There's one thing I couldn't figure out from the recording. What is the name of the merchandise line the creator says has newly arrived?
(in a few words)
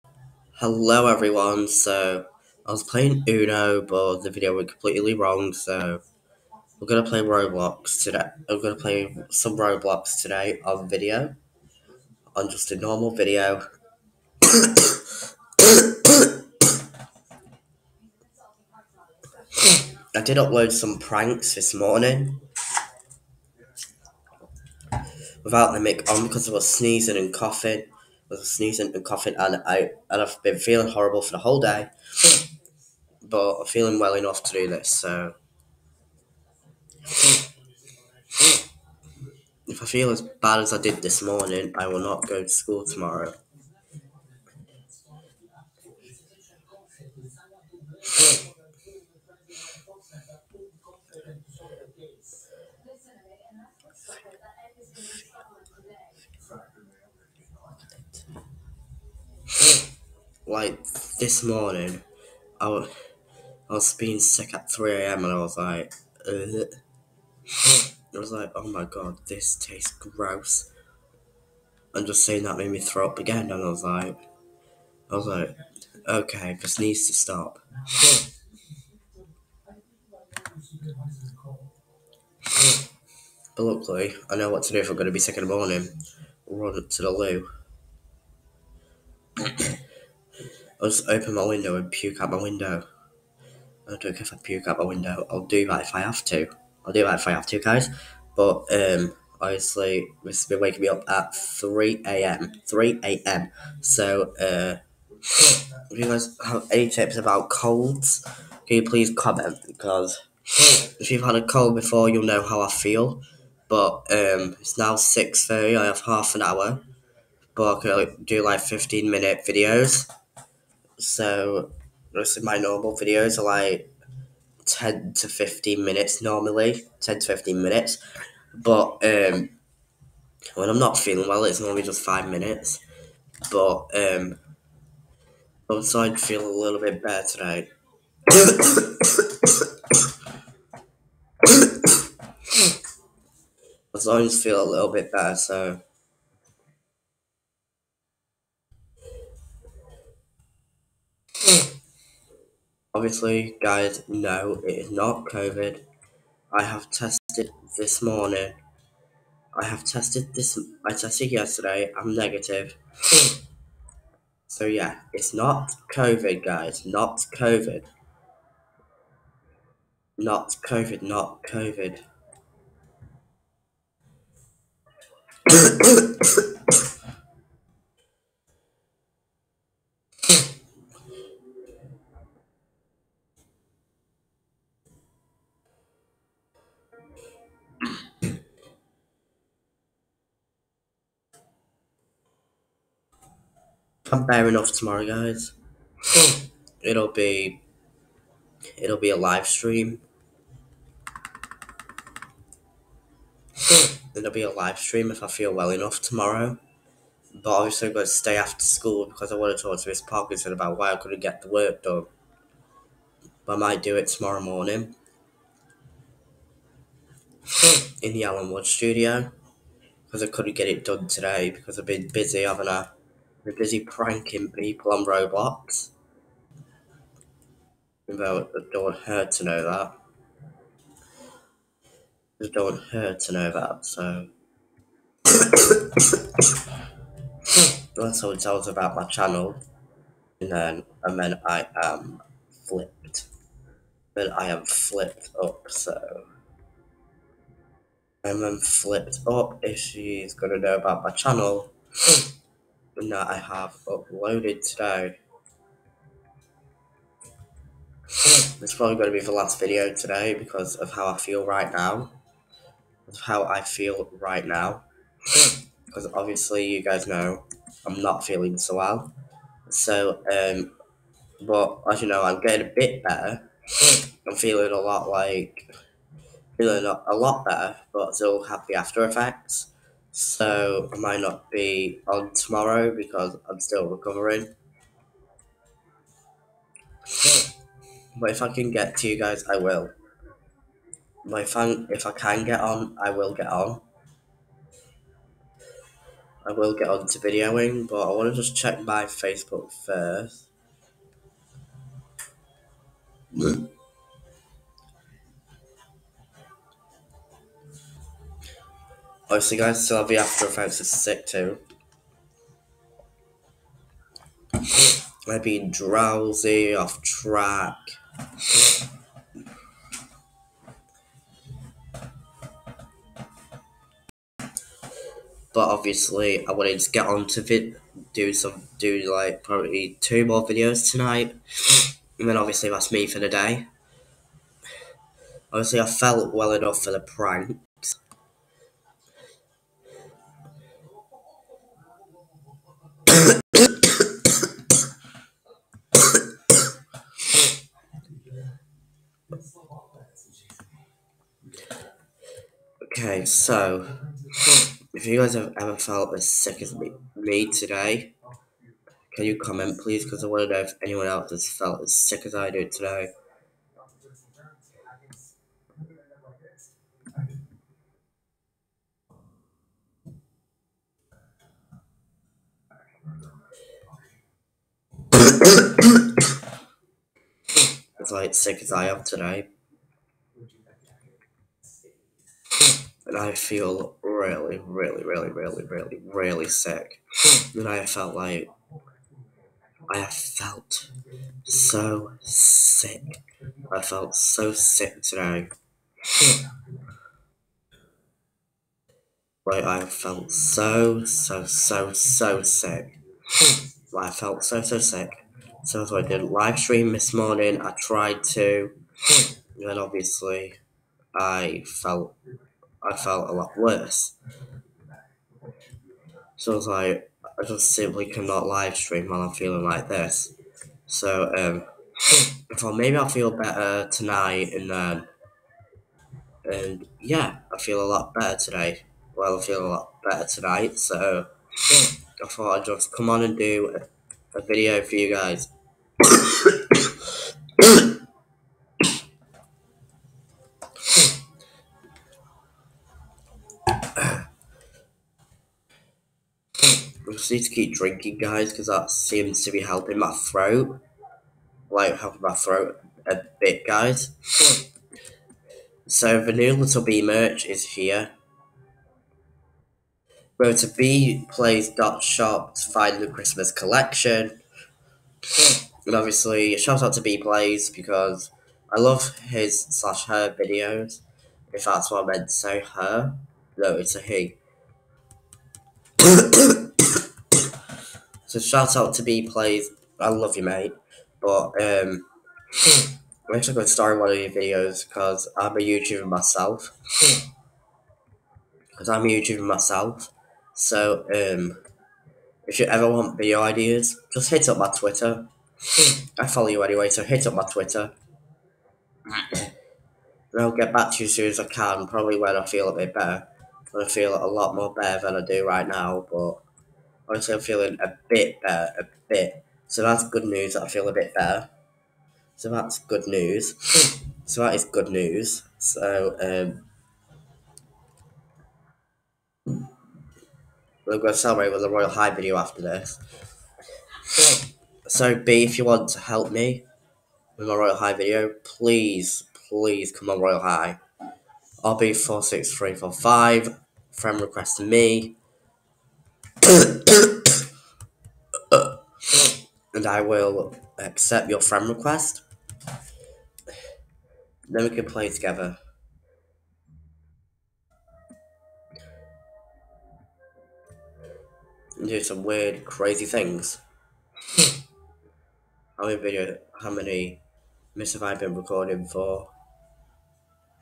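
Little Bee.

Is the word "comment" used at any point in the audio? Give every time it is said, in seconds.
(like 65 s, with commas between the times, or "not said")
109 s, 359 s.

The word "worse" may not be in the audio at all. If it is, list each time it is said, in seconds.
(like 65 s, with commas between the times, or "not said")
413 s.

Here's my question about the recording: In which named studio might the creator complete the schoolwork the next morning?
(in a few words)
Alan Wood studio.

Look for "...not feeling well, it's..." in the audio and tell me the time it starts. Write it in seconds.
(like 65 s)
130 s.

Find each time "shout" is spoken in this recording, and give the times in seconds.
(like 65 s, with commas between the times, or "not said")
466 s, 478 s.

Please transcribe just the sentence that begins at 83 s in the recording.
but luckily, I know what to do if I'm going to be sick in the morning.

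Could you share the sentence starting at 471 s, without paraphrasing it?
If that's what I meant to say, her.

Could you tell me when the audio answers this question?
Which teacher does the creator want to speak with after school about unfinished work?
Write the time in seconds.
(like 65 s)
209 s.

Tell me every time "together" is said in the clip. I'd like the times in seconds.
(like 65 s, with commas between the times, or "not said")
545 s.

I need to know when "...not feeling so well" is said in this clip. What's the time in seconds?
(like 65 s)
268 s.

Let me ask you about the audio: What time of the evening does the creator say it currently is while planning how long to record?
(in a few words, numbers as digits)
6:30.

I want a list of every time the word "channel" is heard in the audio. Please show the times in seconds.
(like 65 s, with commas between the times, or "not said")
239 s, 251 s.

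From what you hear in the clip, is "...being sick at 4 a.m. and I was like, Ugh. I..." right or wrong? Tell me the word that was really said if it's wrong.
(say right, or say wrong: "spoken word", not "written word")
wrong: "3", not "4".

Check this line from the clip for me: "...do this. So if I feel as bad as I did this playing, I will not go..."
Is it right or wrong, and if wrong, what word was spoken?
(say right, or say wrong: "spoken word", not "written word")
wrong: "morning", not "playing".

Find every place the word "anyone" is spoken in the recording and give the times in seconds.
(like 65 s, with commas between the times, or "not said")
360 s.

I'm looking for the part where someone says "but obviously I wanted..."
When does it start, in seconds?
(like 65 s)
324 s.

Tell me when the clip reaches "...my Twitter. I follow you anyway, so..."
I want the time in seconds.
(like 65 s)
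494 s.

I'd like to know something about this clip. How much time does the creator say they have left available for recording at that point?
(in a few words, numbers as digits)
Half an hour.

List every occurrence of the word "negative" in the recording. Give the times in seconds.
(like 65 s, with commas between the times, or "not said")
162 s.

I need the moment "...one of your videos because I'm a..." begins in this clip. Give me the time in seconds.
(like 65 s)
483 s.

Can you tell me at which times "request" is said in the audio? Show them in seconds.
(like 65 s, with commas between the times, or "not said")
534 s, 541 s.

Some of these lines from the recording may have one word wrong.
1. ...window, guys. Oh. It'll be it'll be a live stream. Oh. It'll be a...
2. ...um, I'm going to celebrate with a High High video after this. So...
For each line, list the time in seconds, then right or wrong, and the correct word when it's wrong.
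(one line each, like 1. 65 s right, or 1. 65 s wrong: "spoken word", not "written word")
1. 194 s wrong: "tomorrow", not "window"
2. 516 s wrong: "Royal", not "High".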